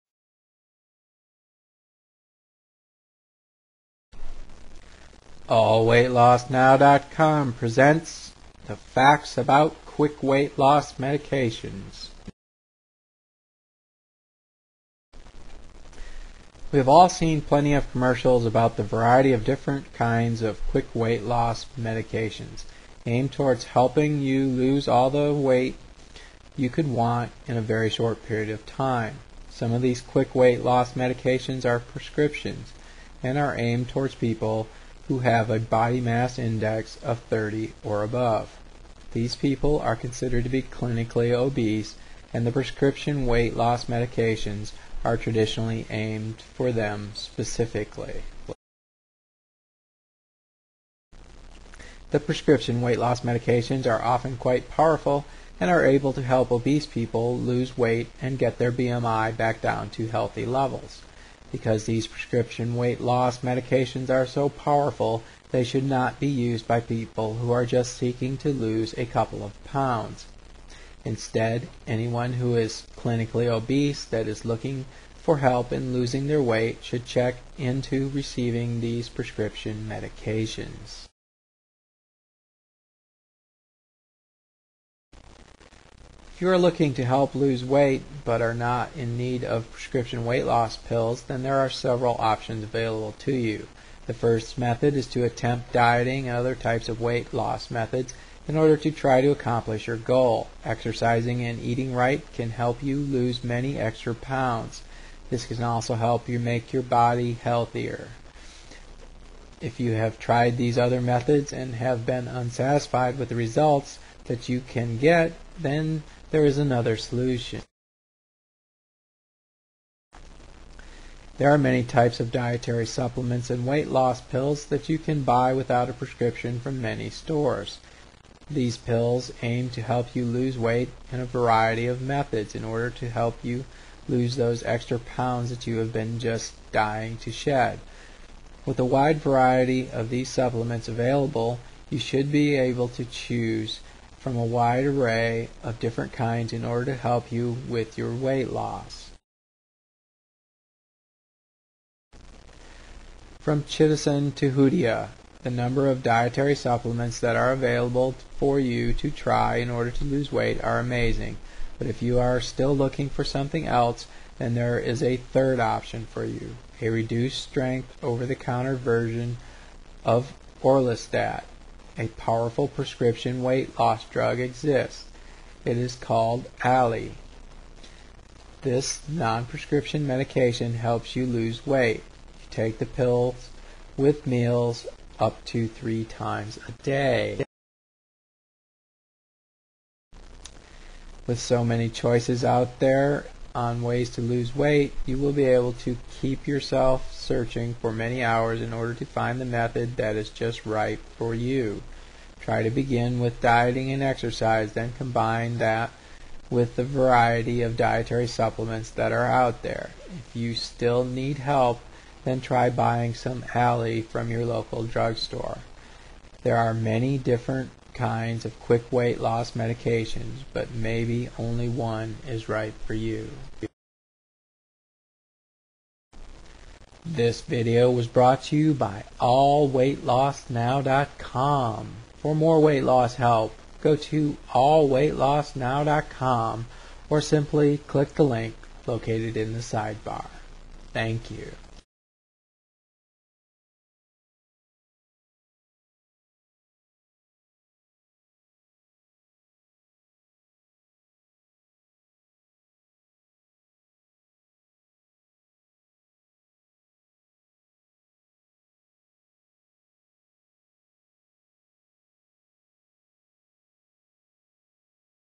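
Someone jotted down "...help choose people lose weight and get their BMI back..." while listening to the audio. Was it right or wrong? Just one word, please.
wrong.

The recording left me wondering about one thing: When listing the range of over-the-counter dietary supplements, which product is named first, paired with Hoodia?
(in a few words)
Chitosan.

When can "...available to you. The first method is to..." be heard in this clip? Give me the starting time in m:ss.
1:32.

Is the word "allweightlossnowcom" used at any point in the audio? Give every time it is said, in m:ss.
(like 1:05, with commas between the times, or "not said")
0:05, 3:49, 3:54.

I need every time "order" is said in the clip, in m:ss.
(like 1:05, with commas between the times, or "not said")
1:38, 2:12, 2:26, 2:39, 3:18.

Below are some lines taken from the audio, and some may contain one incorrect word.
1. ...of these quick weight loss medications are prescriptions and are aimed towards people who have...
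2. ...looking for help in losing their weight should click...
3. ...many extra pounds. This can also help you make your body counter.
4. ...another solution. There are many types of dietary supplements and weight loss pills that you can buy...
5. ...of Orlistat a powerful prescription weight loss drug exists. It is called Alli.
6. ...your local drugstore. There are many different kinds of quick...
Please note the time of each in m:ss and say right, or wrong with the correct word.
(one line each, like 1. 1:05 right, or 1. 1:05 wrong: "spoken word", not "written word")
1. 0:29 right
2. 1:14 wrong: "check", not "click"
3. 1:43 wrong: "healthier", not "counter"
4. 1:56 right
5. 2:50 right
6. 3:34 right.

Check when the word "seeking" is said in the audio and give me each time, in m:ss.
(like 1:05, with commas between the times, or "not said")
1:07.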